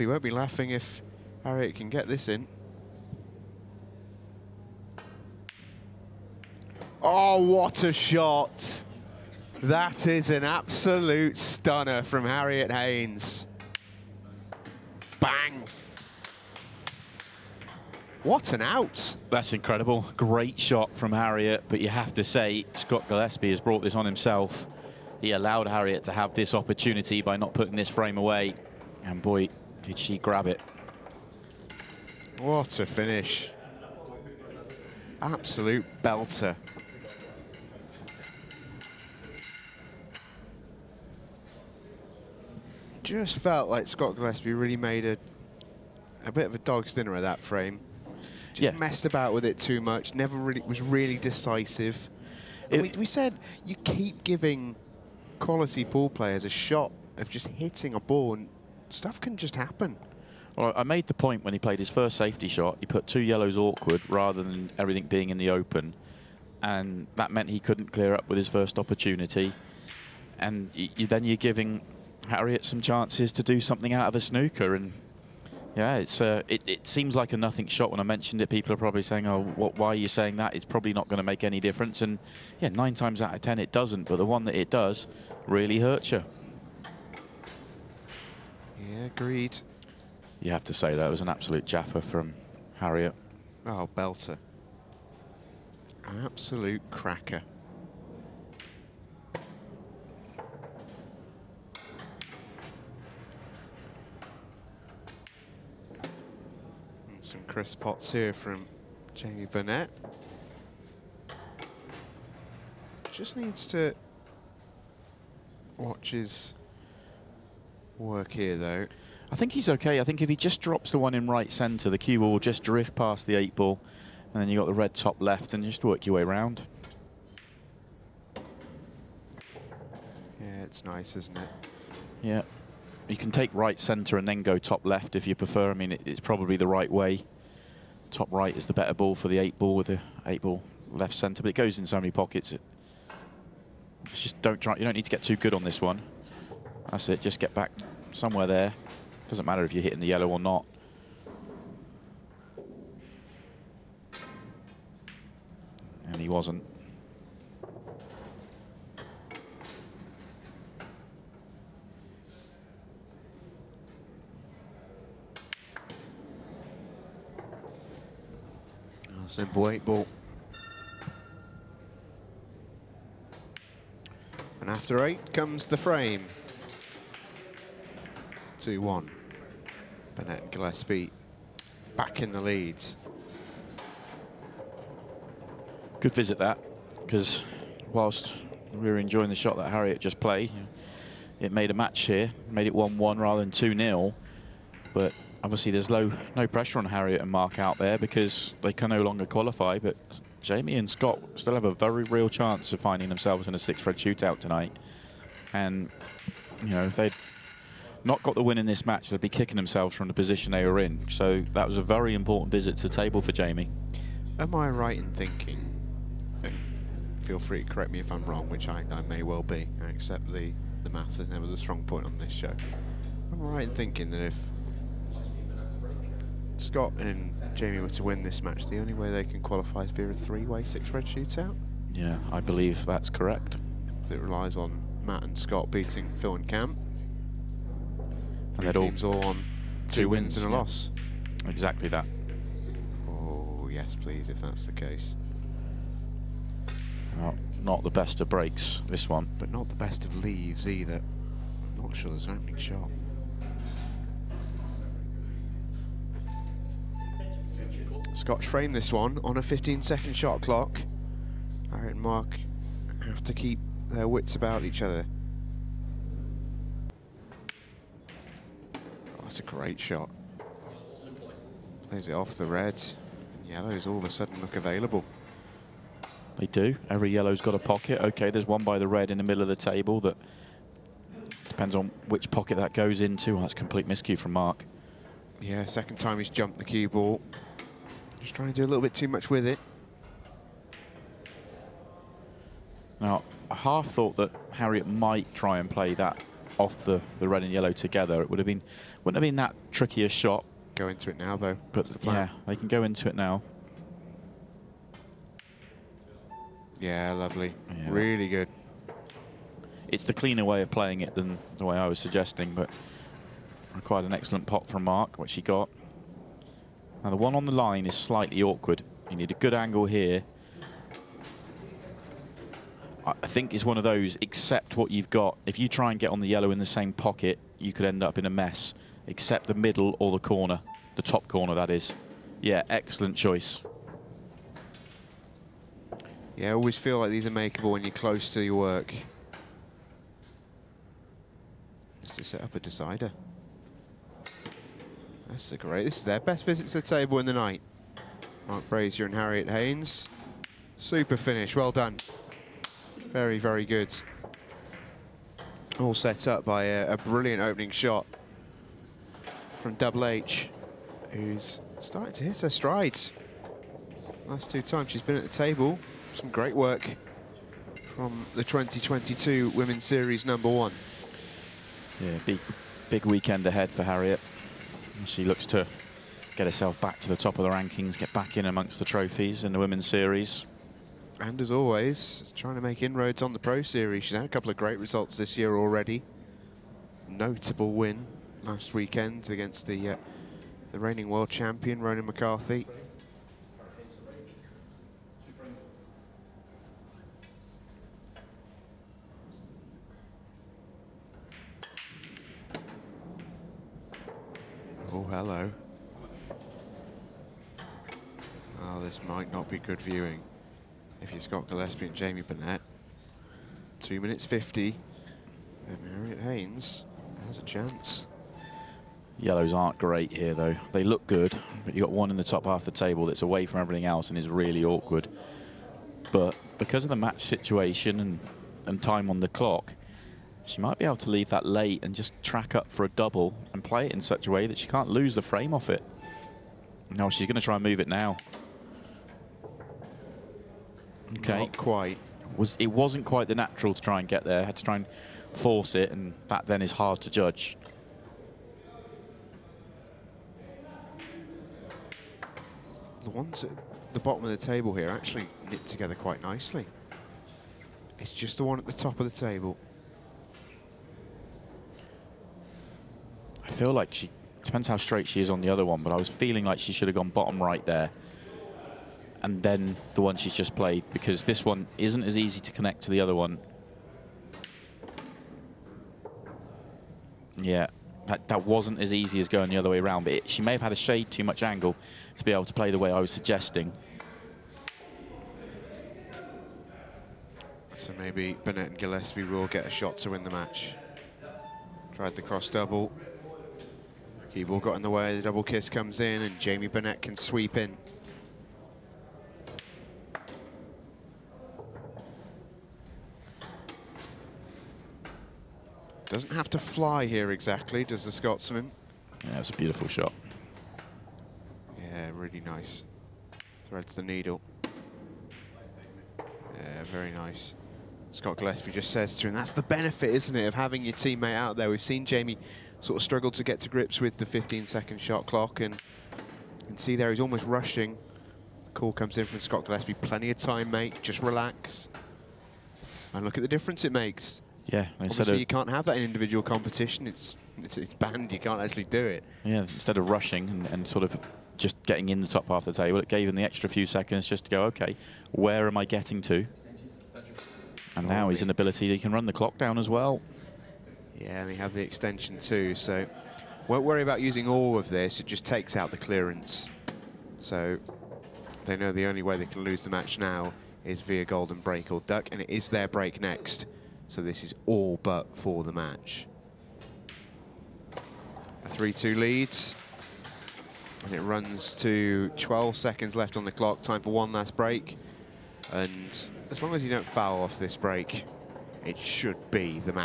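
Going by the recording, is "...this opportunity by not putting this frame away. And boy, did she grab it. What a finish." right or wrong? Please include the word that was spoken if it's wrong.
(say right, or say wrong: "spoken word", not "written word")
right.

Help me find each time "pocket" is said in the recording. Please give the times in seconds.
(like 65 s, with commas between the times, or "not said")
142 s, 277 s, 282 s, 326 s.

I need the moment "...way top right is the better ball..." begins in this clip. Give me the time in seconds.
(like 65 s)
136 s.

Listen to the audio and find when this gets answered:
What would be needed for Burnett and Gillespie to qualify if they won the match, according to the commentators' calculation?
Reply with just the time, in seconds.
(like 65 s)
230 s.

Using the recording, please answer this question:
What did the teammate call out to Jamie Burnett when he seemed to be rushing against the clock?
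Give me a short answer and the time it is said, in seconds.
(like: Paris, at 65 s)
Plenty of time, mate, at 529 s.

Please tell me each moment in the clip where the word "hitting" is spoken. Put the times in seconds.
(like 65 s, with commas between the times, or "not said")
57 s, 149 s.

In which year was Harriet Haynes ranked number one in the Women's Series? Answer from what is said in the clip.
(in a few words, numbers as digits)
2022.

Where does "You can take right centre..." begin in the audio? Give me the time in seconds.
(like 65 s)
133 s.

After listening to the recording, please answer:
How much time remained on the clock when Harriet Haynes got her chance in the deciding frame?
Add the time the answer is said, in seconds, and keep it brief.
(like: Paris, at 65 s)
2 minutes 50, at 413 s.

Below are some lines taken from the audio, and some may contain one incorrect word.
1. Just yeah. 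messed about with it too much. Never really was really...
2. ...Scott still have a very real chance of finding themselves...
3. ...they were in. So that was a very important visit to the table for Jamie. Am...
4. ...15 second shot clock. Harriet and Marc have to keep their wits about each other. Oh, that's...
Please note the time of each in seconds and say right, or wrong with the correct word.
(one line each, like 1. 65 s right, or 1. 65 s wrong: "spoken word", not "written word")
1. 48 s right
2. 200 s right
3. 210 s right
4. 259 s right.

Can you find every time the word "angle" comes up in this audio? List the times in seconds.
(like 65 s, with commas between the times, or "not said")
319 s, 481 s.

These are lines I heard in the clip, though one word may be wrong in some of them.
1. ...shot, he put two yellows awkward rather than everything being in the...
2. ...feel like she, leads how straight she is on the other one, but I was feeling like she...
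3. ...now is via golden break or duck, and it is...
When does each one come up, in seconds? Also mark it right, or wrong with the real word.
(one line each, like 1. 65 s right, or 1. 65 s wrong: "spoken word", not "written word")
1. 62 s right
2. 463 s wrong: "depends", not "leads"
3. 560 s right.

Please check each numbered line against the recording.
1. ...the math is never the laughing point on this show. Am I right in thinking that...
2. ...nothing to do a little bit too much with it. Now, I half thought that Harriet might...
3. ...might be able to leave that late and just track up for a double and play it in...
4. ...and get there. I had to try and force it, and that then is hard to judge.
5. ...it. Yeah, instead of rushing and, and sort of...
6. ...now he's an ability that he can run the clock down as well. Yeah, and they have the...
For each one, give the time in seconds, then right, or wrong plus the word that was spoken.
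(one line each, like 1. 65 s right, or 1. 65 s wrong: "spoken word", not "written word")
1. 220 s wrong: "strong", not "laughing"
2. 288 s wrong: "trying", not "nothing"
3. 430 s right
4. 443 s right
5. 539 s right
6. 548 s right.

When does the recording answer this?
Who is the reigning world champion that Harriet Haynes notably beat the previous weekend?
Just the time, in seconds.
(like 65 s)
391 s.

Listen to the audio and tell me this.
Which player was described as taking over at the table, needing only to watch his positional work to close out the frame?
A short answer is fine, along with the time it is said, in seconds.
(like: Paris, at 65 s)
Chris Potts, at 107 s.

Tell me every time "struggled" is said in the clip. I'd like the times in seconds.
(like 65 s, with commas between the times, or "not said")
523 s.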